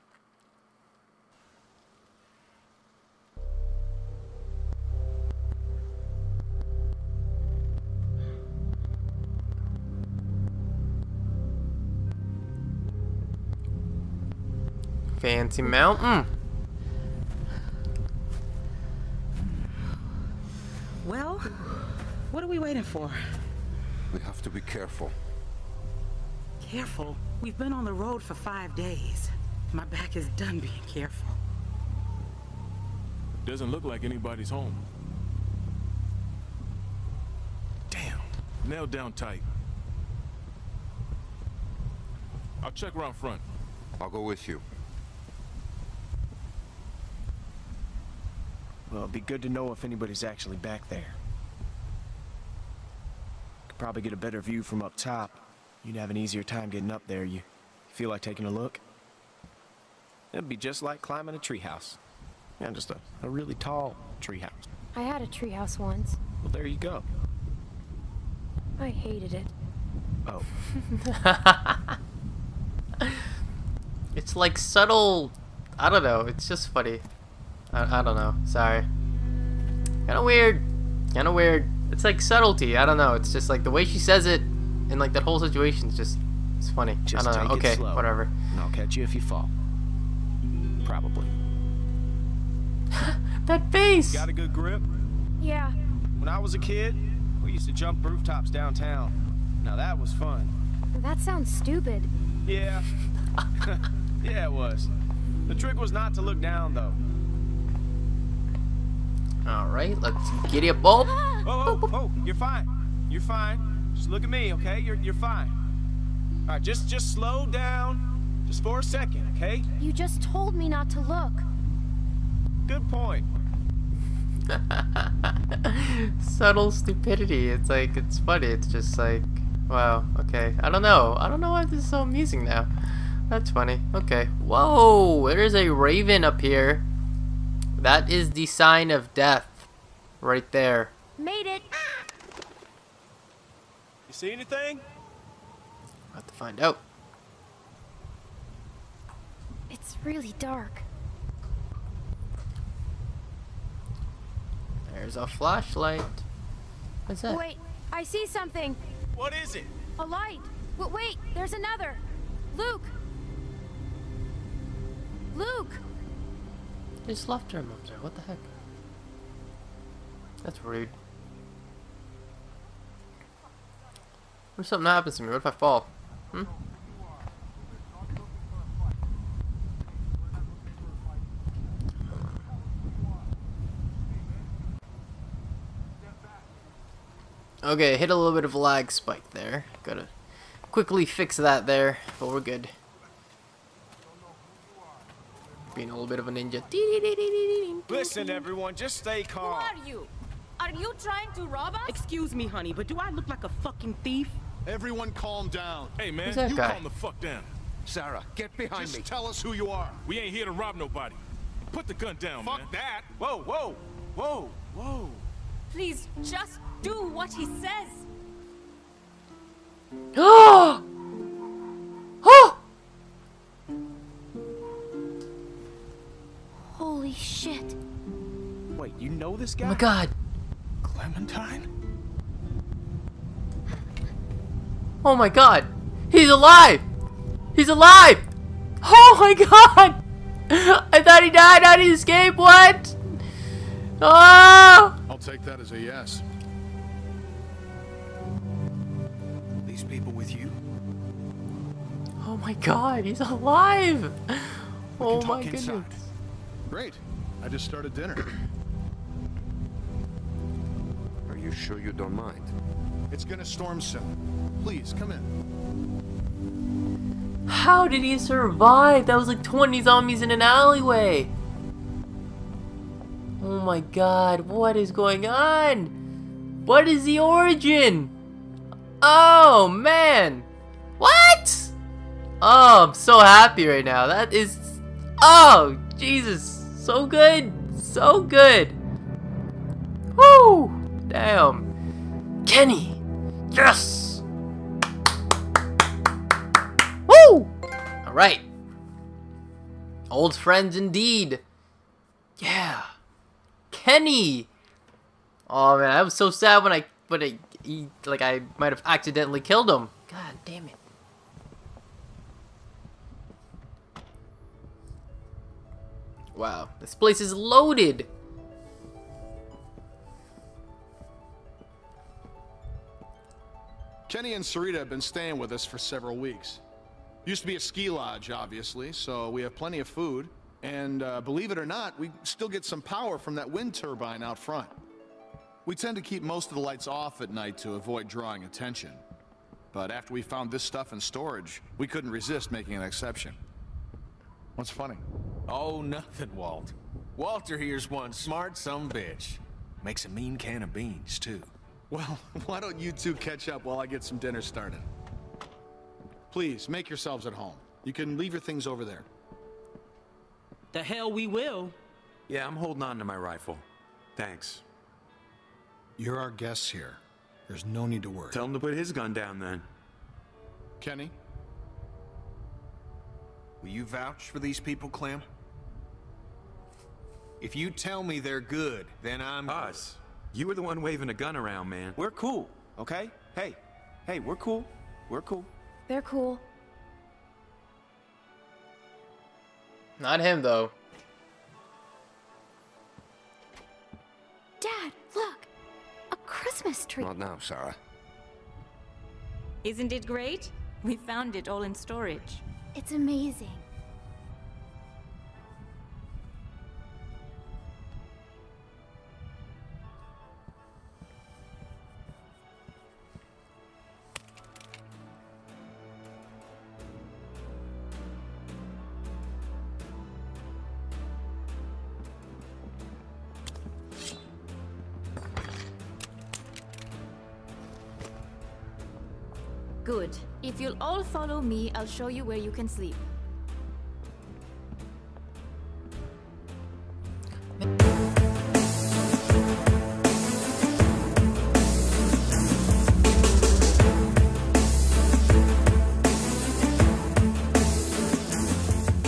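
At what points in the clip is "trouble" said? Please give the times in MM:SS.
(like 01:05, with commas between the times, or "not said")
not said.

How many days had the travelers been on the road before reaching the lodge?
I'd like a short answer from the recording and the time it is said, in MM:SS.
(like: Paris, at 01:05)
5, at 00:28.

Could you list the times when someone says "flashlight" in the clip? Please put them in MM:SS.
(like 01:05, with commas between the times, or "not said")
02:35.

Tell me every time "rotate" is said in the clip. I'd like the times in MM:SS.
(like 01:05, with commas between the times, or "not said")
not said.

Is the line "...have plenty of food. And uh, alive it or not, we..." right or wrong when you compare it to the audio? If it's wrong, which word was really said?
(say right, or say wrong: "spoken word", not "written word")
wrong: "believe", not "alive".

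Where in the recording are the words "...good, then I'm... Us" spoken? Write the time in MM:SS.
06:18.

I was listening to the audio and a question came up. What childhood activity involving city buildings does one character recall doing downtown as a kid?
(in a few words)
Jump rooftops.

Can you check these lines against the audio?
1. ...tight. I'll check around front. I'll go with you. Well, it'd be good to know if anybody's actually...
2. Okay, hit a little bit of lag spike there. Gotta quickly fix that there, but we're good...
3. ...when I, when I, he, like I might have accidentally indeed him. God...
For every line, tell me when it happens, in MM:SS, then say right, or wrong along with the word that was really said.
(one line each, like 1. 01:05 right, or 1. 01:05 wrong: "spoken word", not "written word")
1. 00:39 right
2. 03:07 right
3. 05:06 wrong: "killed", not "indeed".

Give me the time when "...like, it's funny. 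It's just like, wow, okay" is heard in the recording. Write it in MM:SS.
02:07.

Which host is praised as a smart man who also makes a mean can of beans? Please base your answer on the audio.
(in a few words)
Walter.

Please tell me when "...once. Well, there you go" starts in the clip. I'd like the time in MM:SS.
01:05.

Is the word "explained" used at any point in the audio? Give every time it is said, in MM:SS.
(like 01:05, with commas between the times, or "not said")
not said.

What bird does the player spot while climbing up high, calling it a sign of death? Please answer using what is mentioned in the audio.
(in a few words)
Raven.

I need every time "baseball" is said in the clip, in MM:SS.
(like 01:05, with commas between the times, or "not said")
not said.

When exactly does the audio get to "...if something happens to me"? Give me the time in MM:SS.
02:54.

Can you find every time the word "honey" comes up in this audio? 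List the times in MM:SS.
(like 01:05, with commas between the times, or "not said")
03:22.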